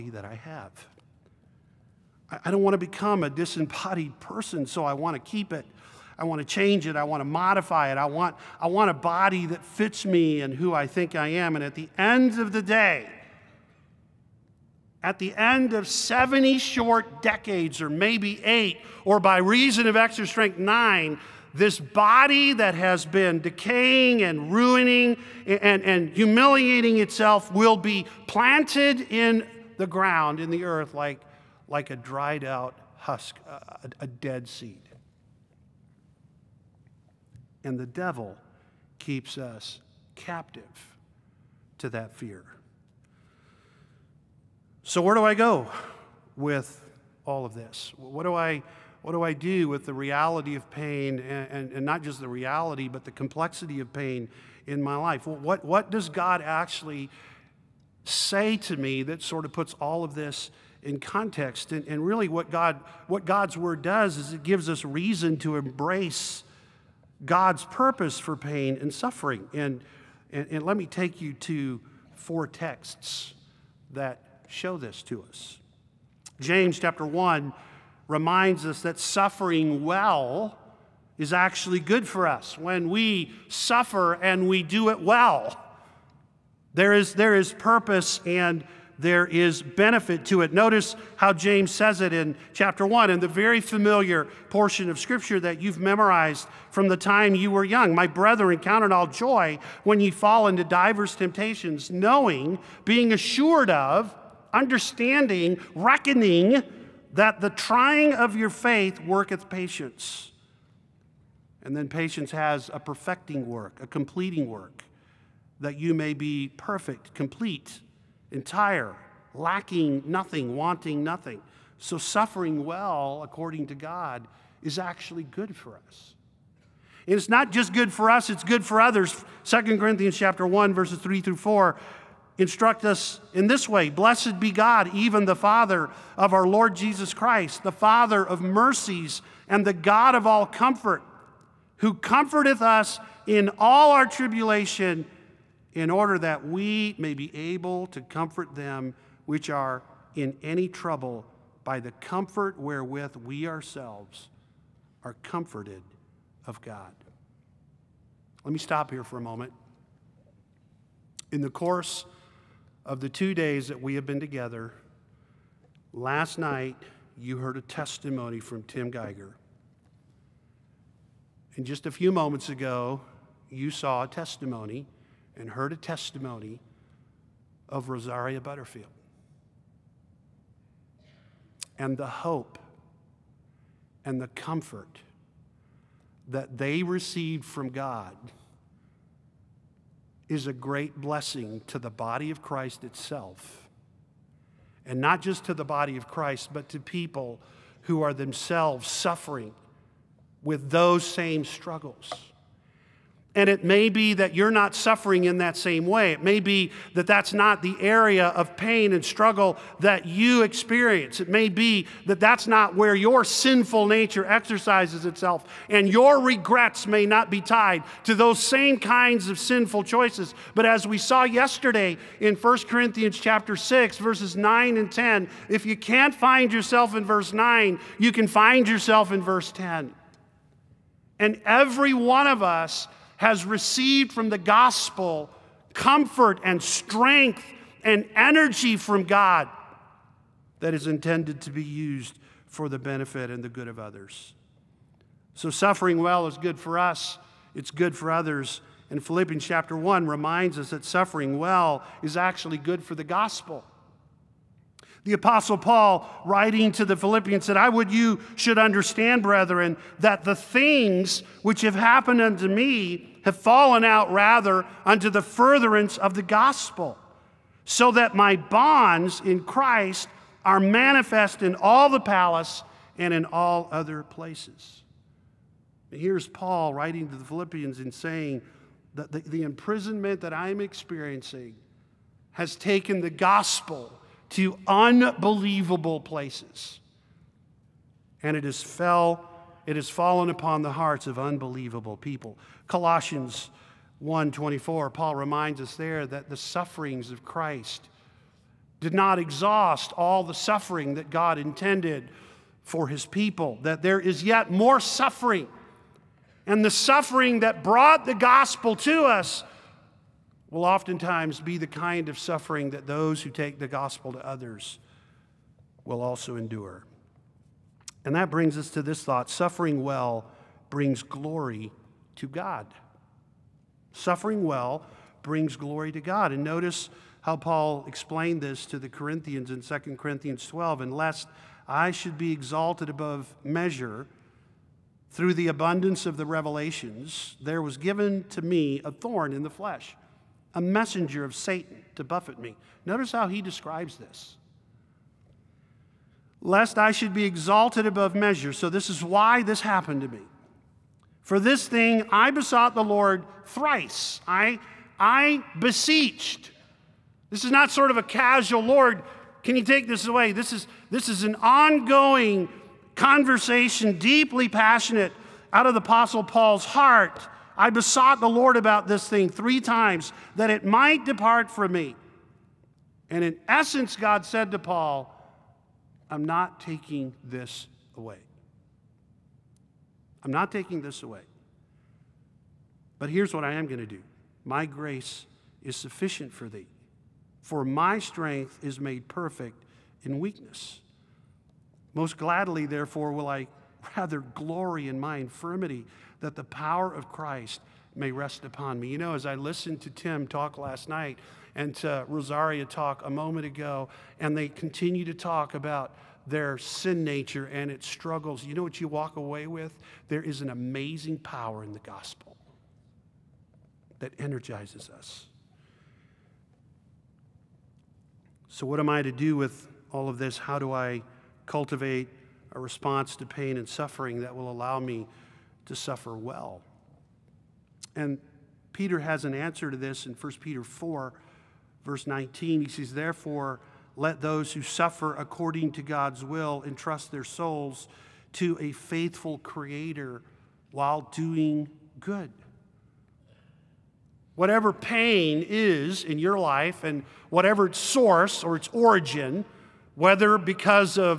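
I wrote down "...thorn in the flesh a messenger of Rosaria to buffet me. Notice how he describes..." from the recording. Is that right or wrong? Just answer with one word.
wrong.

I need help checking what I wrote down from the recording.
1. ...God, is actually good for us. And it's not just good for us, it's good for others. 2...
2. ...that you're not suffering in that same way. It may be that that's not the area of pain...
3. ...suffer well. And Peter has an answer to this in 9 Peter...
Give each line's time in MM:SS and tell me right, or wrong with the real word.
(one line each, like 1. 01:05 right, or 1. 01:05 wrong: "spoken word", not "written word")
1. 02:03 right
2. 03:24 right
3. 07:05 wrong: "1", not "9".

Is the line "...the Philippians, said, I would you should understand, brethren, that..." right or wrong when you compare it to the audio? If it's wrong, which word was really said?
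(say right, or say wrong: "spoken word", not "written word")
right.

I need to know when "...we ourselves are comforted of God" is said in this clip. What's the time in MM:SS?
02:33.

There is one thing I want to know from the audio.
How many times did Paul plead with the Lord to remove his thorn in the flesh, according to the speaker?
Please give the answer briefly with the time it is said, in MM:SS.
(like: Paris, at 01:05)
3, at 06:09.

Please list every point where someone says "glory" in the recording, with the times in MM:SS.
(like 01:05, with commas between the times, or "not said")
05:21, 05:25, 06:34.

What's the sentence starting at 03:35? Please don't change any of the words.
And your regrets may not be tied to those same kinds of sinful choices.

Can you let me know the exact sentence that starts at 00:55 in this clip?
what, what does God actually say to me that sort of puts all of this in context?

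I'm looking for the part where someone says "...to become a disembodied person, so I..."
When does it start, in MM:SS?
00:02.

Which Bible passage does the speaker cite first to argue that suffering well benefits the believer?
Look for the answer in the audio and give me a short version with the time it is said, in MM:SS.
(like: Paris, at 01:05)
James chapter 1, at 01:16.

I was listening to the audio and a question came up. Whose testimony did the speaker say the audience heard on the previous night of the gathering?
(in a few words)
Tim Geiger.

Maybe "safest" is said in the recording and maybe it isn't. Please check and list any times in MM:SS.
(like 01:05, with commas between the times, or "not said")
not said.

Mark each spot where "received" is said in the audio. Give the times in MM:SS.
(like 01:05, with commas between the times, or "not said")
03:06, 03:53.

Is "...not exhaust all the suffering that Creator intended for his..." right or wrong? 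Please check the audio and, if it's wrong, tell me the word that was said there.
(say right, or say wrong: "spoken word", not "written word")
wrong: "God", not "Creator".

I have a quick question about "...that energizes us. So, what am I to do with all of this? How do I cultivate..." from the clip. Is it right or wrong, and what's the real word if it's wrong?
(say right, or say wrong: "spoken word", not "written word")
right.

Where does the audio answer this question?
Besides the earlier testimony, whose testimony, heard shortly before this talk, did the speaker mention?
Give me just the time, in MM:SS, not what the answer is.
02:57.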